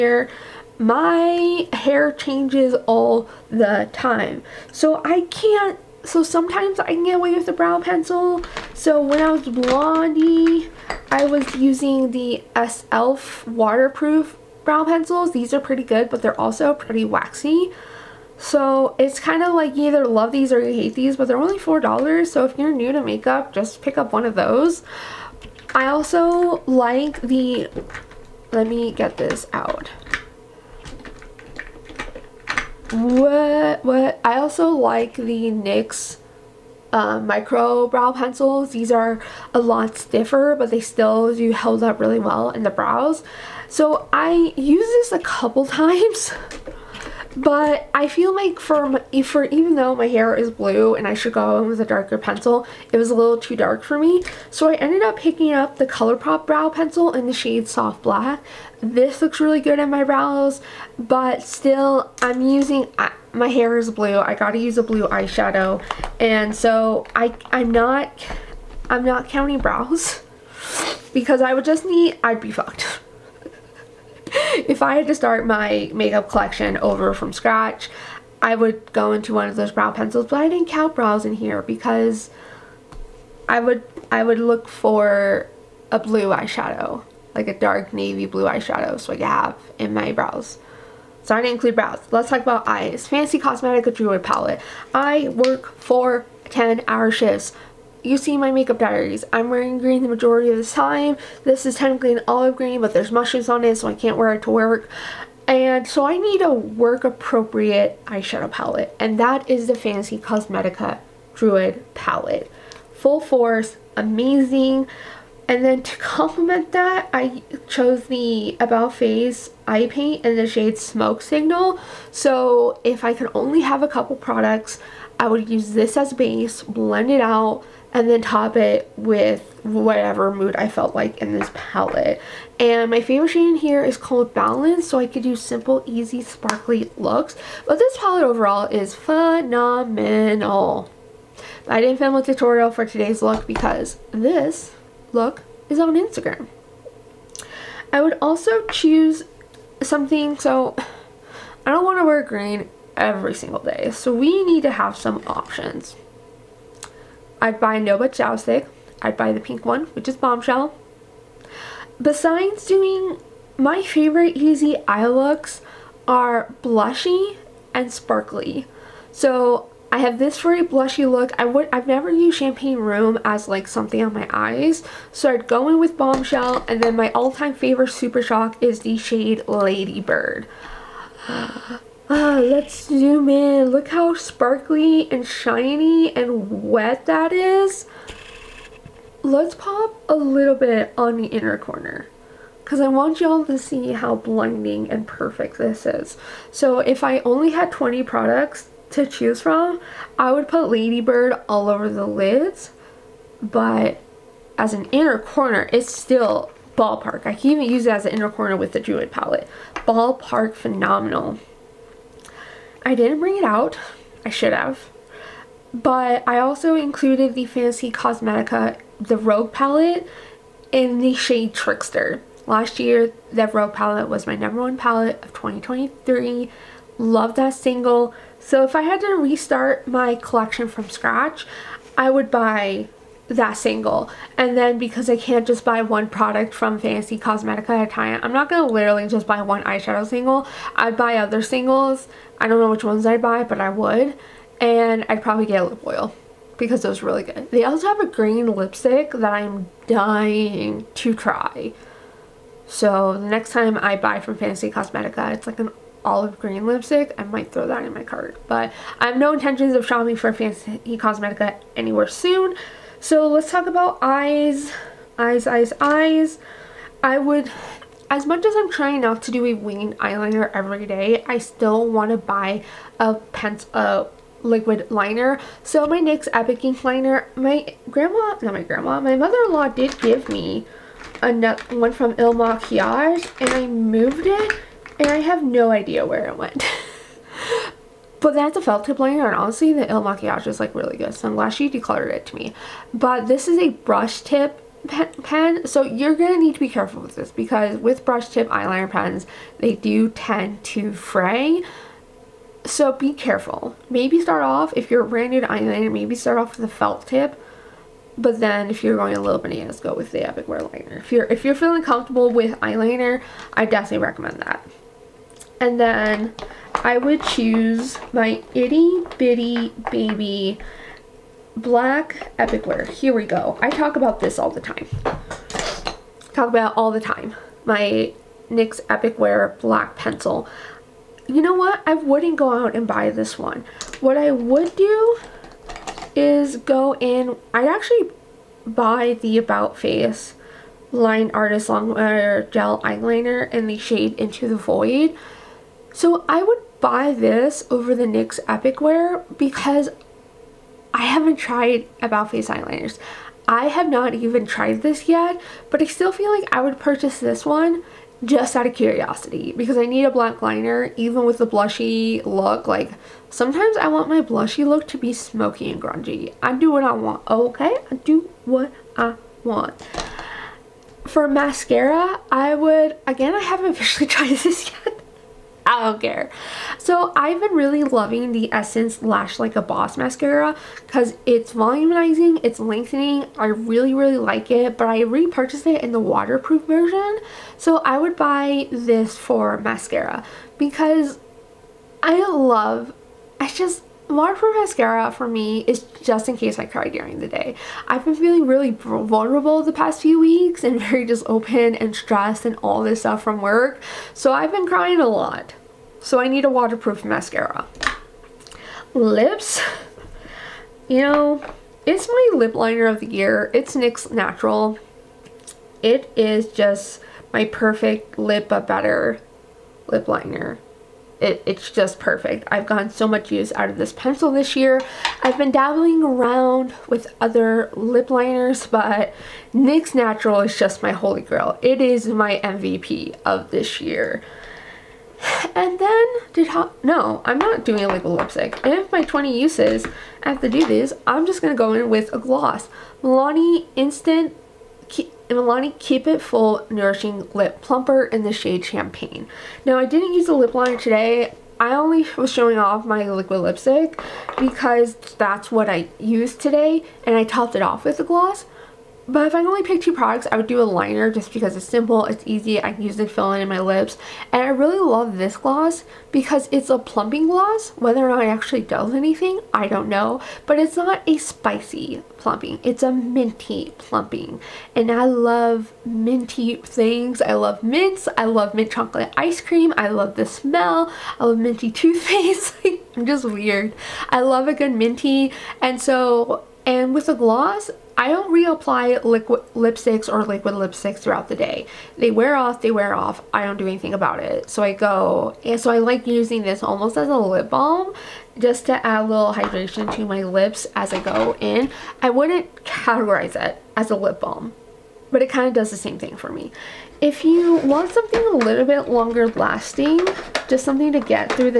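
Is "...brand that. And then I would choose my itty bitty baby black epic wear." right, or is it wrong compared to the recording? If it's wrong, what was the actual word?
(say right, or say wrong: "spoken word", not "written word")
wrong: "recommend", not "brand".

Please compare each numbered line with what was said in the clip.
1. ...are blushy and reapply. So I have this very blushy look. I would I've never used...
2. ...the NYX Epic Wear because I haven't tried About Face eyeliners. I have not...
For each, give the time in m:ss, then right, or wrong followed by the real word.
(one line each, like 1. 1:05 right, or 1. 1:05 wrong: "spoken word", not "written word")
1. 2:46 wrong: "sparkly", not "reapply"
2. 5:47 right.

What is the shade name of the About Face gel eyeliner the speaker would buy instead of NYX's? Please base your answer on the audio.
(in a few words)
Into the Void.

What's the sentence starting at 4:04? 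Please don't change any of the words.
And I'd probably get a lip oil because it was really good.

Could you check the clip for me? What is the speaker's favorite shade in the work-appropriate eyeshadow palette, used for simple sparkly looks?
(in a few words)
Balance.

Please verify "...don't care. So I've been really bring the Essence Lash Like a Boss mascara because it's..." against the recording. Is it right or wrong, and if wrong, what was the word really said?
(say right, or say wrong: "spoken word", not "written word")
wrong: "loving", not "bring".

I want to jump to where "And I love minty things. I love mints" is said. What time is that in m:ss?
7:54.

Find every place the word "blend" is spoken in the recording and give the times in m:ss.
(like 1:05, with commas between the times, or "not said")
2:06.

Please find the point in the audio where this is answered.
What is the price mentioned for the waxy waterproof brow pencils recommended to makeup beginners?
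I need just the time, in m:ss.
0:21.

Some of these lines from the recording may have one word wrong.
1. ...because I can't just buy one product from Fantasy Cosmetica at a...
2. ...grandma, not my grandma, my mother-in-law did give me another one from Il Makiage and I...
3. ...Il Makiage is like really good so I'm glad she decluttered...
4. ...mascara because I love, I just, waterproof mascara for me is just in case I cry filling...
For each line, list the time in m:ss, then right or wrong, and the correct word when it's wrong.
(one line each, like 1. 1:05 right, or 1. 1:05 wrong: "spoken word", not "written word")
1. 3:54 right
2. 4:37 right
3. 4:49 right
4. 6:29 wrong: "during", not "filling".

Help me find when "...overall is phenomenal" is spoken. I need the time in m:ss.
2:18.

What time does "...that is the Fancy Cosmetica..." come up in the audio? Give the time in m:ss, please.
1:49.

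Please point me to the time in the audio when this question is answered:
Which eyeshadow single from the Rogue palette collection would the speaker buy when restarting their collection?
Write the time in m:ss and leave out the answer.
3:41.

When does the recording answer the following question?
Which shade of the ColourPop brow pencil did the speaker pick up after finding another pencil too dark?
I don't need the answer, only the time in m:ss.
0:57.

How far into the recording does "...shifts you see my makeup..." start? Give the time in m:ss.
1:37.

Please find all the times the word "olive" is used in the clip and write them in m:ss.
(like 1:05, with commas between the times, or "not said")
1:42, 4:16.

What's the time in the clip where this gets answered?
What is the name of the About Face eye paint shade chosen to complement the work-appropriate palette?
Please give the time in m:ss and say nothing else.
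2:00.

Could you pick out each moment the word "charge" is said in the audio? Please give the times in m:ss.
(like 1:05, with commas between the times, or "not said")
not said.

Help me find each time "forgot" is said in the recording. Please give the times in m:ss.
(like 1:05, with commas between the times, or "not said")
not said.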